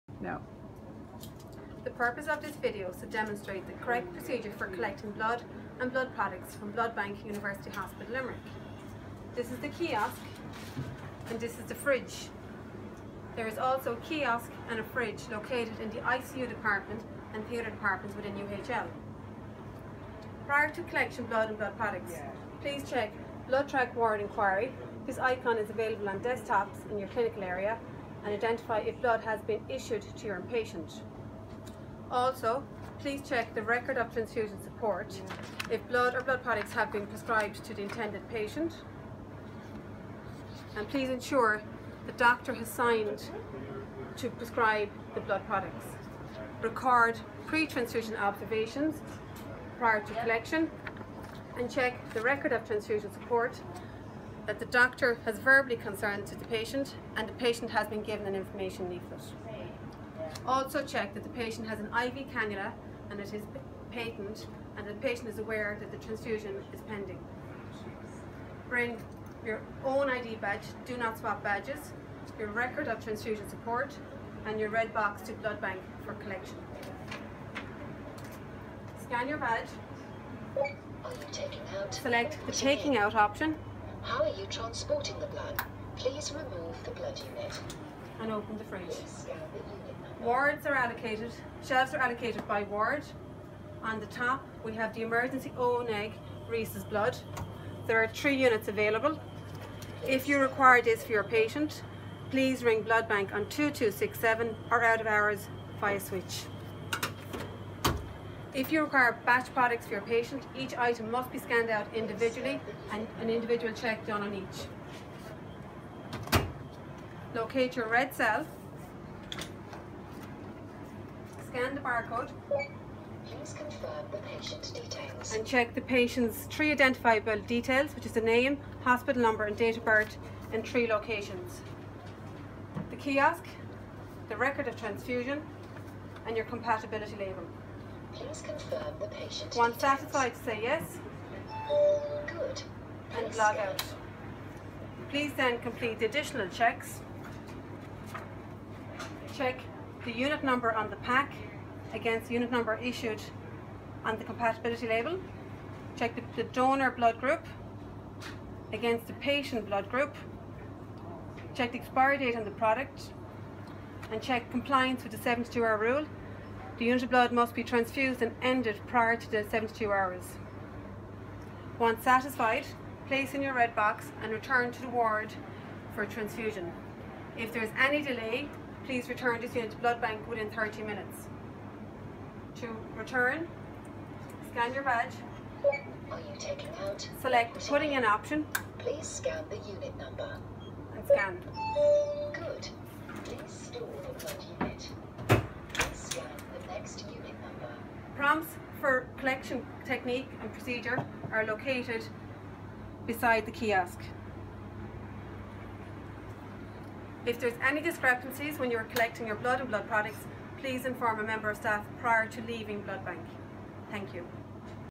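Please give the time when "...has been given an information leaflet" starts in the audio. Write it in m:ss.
0:57.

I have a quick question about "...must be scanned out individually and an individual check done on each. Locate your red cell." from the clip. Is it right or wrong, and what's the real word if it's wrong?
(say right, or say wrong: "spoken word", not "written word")
right.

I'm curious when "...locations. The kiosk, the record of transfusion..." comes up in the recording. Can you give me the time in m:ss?
2:10.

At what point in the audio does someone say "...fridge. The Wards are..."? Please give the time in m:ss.
1:28.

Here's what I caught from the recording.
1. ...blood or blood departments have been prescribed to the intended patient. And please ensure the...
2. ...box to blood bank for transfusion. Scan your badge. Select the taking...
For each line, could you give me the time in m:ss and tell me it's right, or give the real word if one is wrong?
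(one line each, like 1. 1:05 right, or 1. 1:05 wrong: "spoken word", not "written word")
1. 0:35 wrong: "products", not "departments"
2. 1:14 wrong: "collection", not "transfusion".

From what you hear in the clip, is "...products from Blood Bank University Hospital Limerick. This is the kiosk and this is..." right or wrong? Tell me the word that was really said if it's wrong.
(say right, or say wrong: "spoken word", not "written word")
right.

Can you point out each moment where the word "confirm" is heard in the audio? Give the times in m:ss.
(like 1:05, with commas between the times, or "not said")
2:03, 2:18.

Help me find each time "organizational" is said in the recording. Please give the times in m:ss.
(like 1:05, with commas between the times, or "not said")
not said.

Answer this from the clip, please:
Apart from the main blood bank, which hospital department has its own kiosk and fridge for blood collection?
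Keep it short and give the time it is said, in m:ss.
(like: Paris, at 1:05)
ICU, at 0:16.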